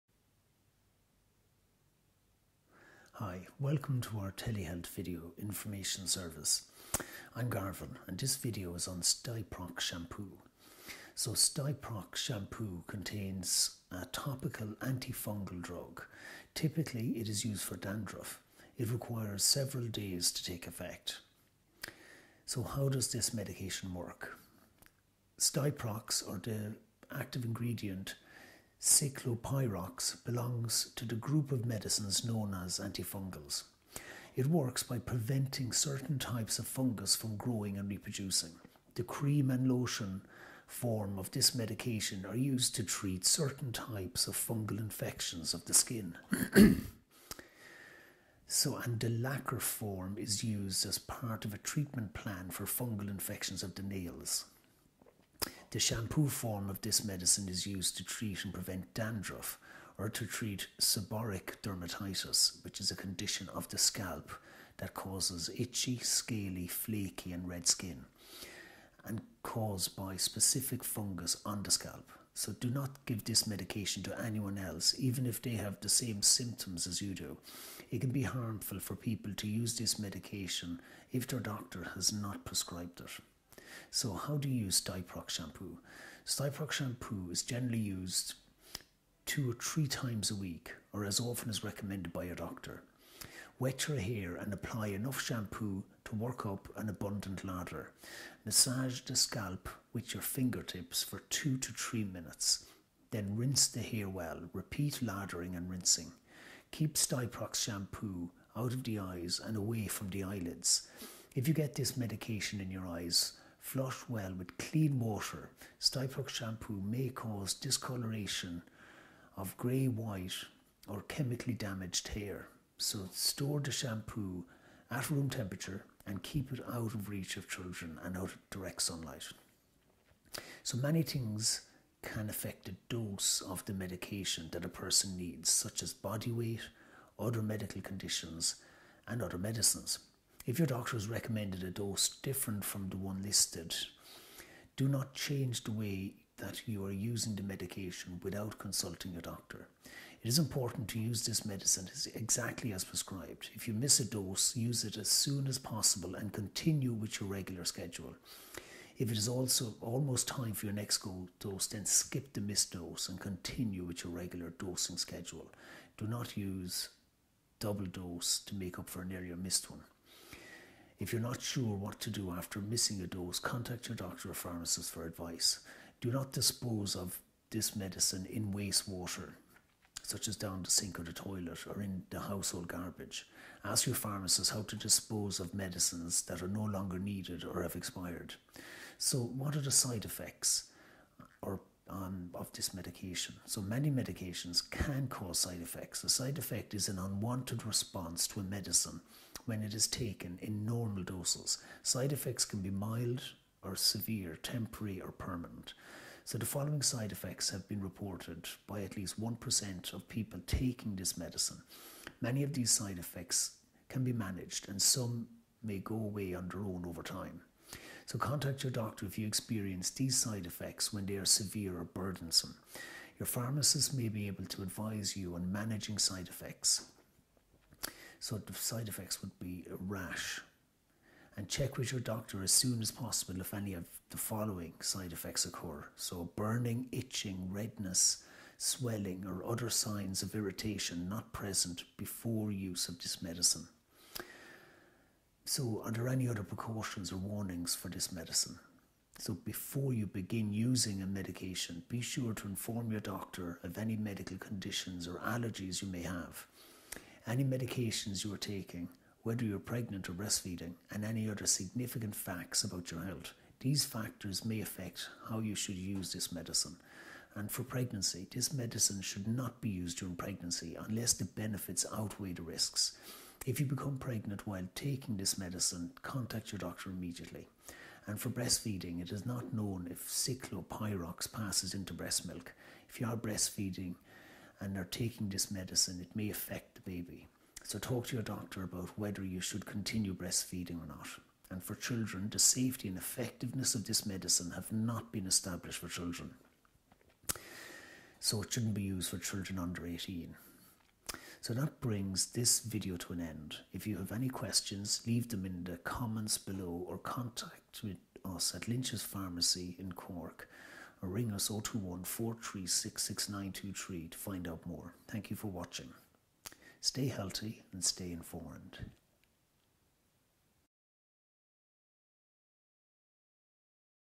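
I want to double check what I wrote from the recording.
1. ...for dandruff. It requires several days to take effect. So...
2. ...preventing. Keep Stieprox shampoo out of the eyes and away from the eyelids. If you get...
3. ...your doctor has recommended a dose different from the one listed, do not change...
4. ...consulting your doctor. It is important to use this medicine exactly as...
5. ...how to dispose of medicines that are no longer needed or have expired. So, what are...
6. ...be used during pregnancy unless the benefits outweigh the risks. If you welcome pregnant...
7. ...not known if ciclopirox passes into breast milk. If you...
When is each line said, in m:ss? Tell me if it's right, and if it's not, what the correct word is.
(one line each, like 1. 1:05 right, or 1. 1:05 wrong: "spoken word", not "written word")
1. 0:17 right
2. 1:45 wrong: "rinsing", not "preventing"
3. 2:20 right
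4. 2:28 right
5. 3:04 right
6. 4:29 wrong: "become", not "welcome"
7. 4:39 right.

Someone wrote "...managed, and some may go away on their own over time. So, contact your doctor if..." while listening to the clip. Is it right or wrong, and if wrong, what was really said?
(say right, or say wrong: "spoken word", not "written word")
right.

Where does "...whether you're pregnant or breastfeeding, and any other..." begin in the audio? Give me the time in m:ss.
4:19.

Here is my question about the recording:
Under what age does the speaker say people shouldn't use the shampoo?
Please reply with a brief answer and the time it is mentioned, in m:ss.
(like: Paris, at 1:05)
18, at 4:59.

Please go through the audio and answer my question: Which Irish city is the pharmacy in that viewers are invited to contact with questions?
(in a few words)
Cork.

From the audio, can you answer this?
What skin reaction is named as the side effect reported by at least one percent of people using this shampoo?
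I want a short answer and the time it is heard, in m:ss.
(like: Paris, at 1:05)
Rash, at 3:49.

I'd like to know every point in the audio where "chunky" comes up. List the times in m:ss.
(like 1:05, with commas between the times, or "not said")
not said.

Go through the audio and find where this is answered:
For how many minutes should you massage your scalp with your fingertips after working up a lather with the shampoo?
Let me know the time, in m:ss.
1:41.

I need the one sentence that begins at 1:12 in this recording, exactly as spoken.
So do not give this medication to anyone else, even if they have the same symptoms as you do.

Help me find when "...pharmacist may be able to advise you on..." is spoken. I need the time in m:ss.
3:43.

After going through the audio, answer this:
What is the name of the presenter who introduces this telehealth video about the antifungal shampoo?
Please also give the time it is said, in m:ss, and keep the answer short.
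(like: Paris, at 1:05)
Garvin, at 0:07.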